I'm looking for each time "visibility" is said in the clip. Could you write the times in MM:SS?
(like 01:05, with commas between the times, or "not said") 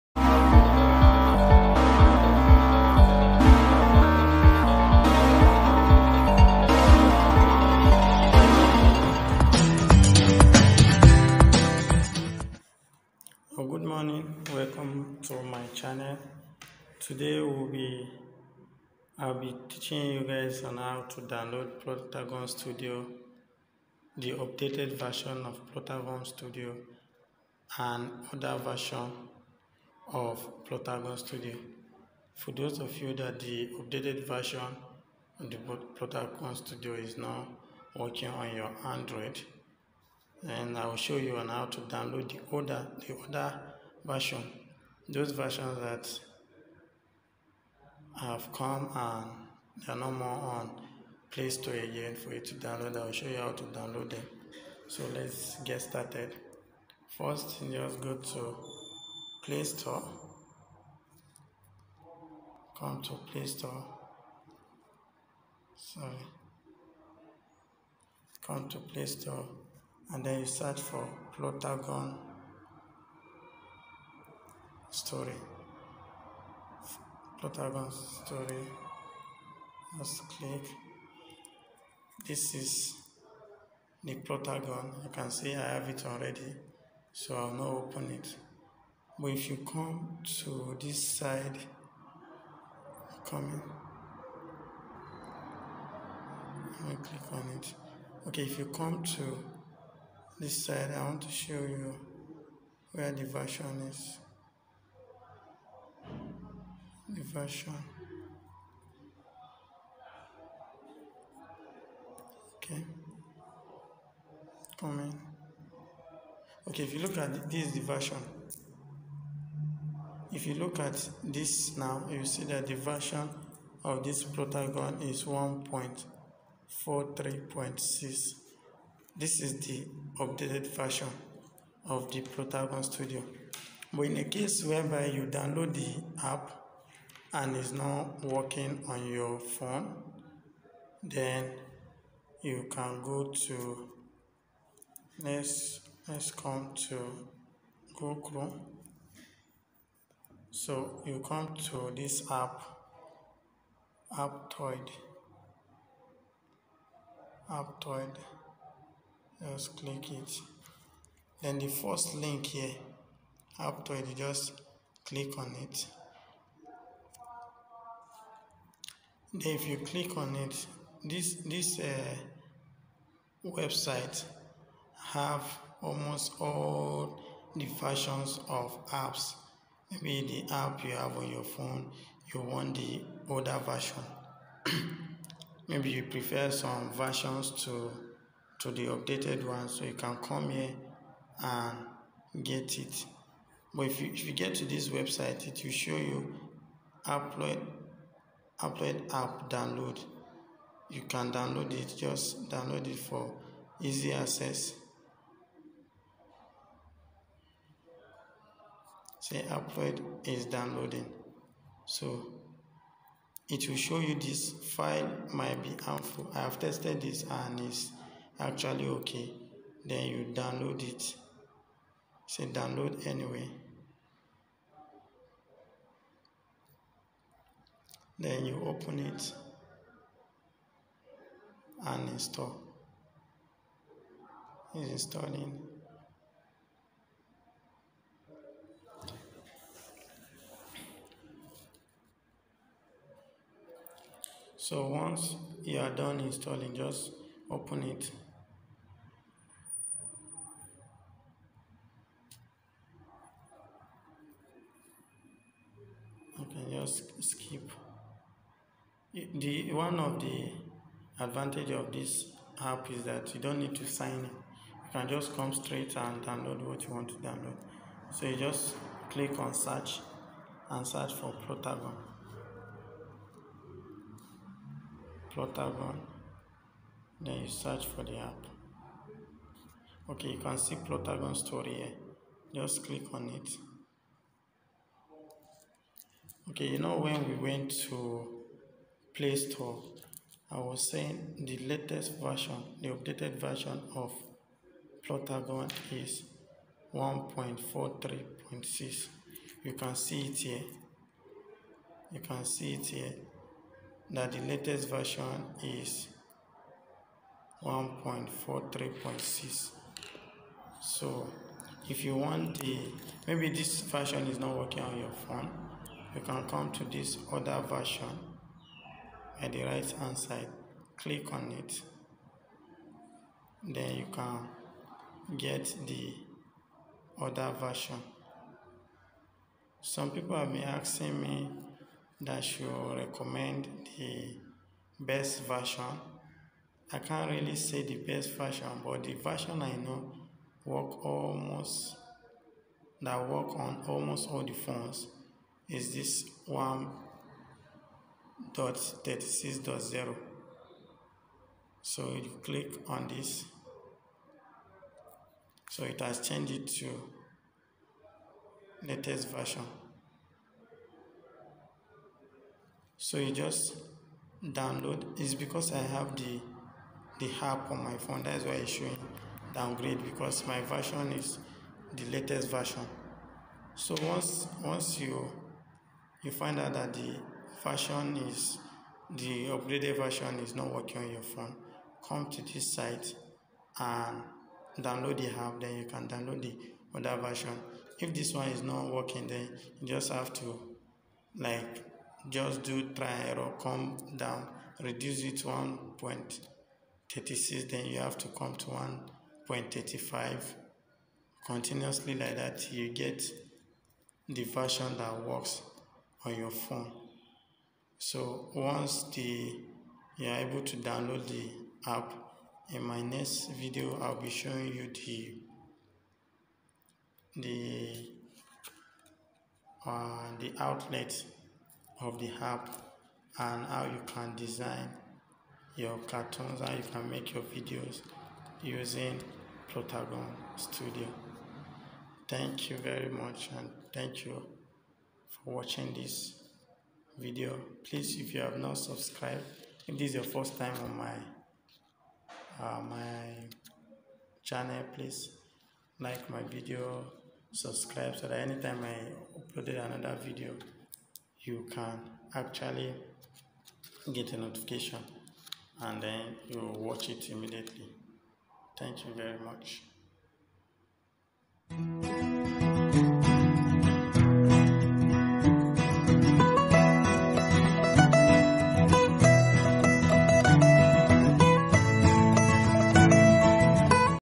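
not said.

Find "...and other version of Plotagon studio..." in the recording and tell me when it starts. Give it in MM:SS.
00:27.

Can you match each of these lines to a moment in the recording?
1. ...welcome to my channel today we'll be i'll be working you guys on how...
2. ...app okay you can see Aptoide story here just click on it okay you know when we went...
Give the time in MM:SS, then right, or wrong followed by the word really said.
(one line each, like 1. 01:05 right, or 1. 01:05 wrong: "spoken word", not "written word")
1. 00:14 wrong: "teaching", not "working"
2. 04:38 wrong: "Plotagon", not "Aptoide".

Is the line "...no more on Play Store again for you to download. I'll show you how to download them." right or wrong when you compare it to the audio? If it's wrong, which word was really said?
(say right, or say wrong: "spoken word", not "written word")
right.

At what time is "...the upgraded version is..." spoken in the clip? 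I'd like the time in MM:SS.
06:19.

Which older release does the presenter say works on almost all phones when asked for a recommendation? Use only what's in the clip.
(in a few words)
36.0.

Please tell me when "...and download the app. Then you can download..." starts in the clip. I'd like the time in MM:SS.
06:23.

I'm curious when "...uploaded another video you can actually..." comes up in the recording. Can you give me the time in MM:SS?
07:29.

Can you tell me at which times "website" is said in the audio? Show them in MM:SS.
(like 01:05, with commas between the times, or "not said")
02:53, 03:14.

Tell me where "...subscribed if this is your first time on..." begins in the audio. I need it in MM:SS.
07:18.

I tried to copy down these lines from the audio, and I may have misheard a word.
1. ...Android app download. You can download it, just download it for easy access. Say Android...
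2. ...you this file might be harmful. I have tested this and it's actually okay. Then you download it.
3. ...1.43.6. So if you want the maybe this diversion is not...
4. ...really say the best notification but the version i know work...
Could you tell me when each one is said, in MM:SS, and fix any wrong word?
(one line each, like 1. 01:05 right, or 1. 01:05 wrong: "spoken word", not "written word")
1. 03:18 right
2. 03:33 right
3. 05:07 wrong: "version", not "diversion"
4. 05:37 wrong: "version", not "notification".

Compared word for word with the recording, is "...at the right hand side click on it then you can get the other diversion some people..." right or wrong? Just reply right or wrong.
wrong.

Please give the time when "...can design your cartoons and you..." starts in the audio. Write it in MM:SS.
07:04.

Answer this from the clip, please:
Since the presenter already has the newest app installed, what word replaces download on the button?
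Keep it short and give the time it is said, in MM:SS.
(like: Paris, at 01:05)
Downgrade, at 06:09.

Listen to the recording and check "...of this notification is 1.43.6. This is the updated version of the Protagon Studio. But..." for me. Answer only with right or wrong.
wrong.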